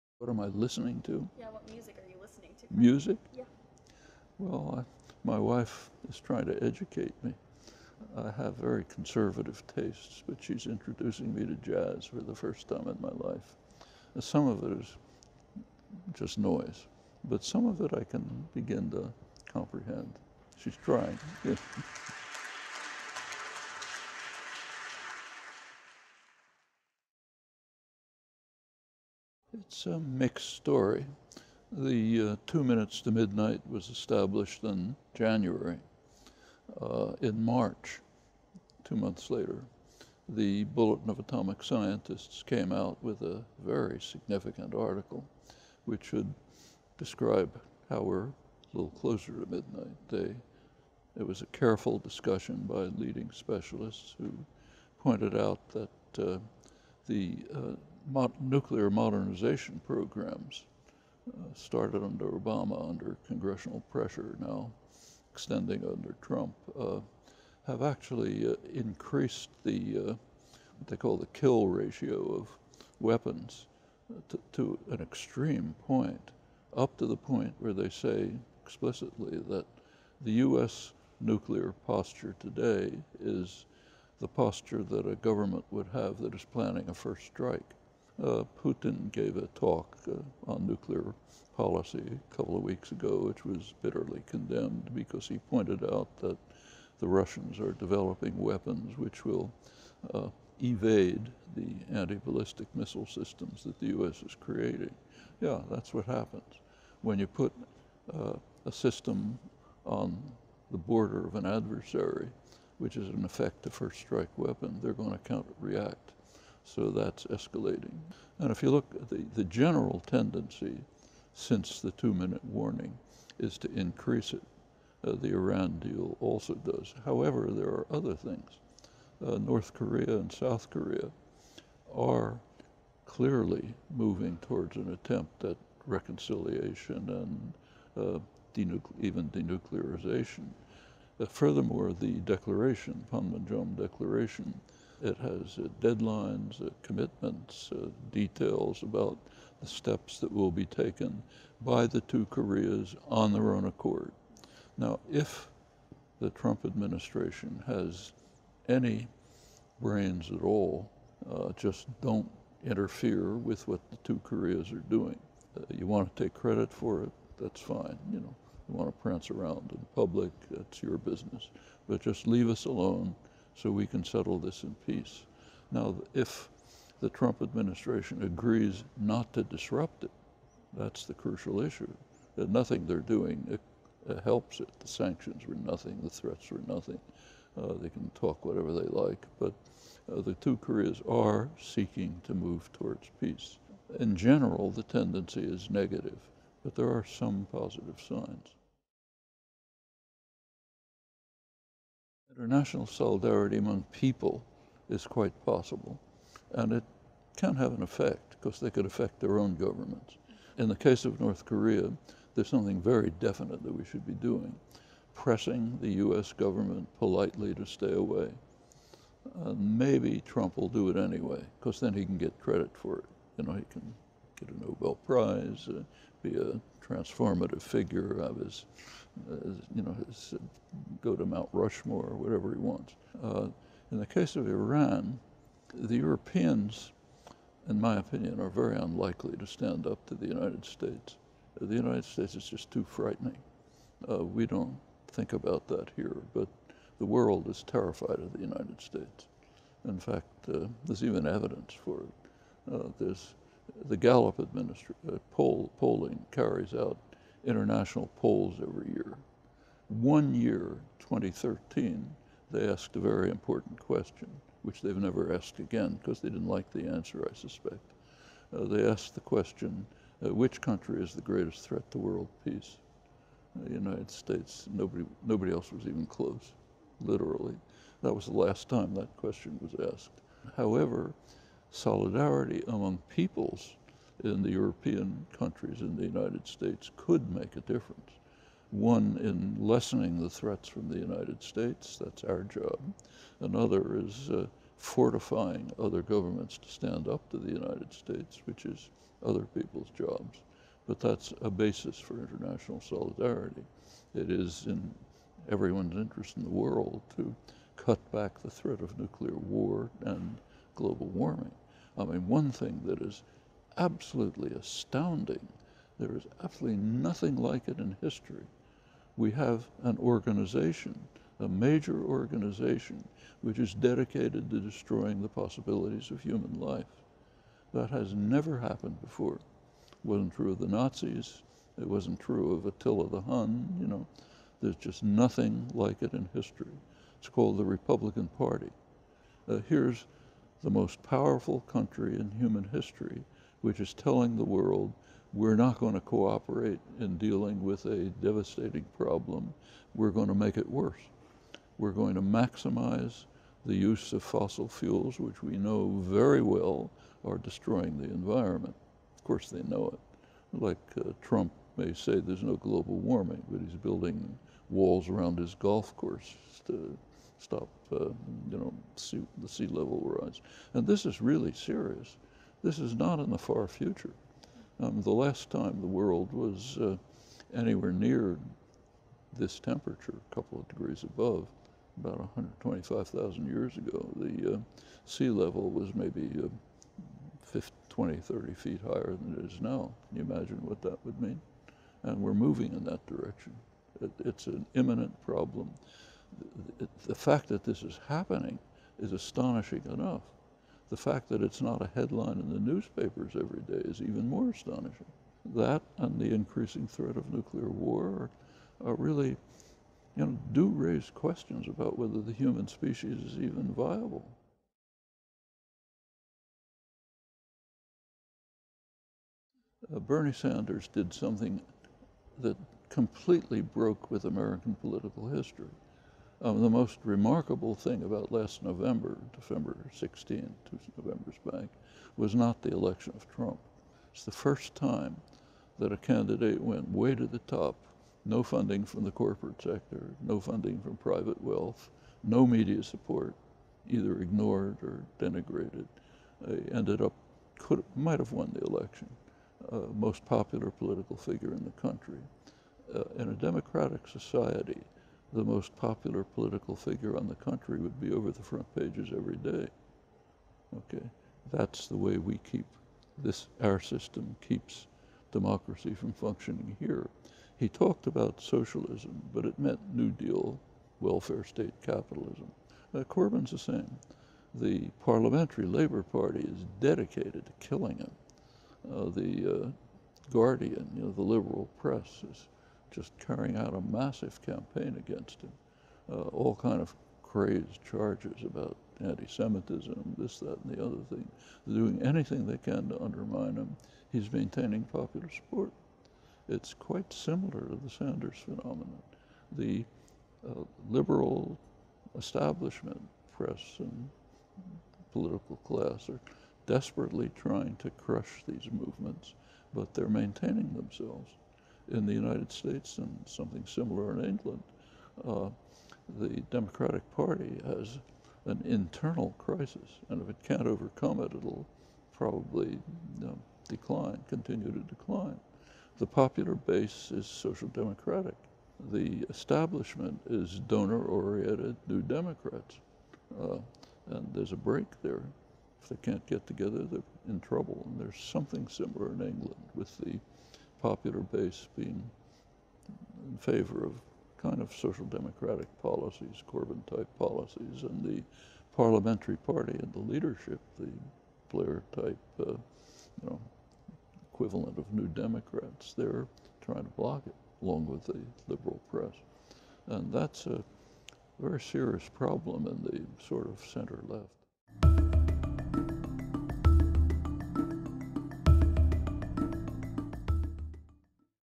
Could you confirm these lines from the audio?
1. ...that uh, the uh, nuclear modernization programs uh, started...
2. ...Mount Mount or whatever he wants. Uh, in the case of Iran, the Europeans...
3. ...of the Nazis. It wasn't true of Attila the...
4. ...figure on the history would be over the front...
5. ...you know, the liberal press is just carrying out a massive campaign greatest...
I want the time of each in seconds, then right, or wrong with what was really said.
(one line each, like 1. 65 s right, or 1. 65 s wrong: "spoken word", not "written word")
1. 55 s right
2. 231 s wrong: "Rushmore", not "Mount"
3. 330 s right
4. 456 s wrong: "country", not "history"
5. 480 s wrong: "against", not "greatest".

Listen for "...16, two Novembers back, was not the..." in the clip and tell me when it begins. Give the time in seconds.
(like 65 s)
429 s.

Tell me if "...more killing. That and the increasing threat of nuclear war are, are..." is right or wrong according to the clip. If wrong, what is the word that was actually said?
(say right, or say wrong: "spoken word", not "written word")
wrong: "astonishing", not "killing".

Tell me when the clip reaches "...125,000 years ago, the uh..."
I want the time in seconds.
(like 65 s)
382 s.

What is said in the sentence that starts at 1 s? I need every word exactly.
Yeah, what music are you listening to?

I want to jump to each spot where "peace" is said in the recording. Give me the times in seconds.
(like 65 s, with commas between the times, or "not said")
174 s, 193 s, 272 s.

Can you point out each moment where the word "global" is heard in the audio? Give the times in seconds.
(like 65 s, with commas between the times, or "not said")
310 s, 362 s.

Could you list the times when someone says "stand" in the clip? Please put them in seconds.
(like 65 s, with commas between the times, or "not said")
239 s, 296 s.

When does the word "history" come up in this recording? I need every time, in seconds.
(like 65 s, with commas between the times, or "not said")
317 s, 336 s, 342 s, 425 s.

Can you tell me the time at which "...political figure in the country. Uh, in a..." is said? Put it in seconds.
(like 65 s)
450 s.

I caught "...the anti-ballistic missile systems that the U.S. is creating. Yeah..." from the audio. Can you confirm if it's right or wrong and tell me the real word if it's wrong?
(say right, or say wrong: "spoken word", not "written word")
right.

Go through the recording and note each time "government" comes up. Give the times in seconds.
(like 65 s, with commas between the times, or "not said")
85 s, 209 s, 216 s, 296 s.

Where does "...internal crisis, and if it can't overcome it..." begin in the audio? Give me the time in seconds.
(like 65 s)
518 s.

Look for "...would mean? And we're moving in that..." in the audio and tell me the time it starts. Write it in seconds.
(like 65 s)
391 s.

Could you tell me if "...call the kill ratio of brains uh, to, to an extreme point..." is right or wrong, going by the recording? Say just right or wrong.
wrong.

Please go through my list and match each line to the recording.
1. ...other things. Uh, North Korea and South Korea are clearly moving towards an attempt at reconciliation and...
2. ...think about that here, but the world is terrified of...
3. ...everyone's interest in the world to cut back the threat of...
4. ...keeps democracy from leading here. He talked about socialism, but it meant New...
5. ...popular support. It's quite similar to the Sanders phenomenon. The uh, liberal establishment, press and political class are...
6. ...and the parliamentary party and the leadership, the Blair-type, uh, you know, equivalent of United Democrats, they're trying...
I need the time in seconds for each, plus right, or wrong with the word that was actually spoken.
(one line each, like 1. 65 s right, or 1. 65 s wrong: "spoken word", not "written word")
1. 127 s right
2. 245 s right
3. 305 s right
4. 464 s wrong: "functioning", not "leading"
5. 494 s right
6. 547 s wrong: "New", not "United".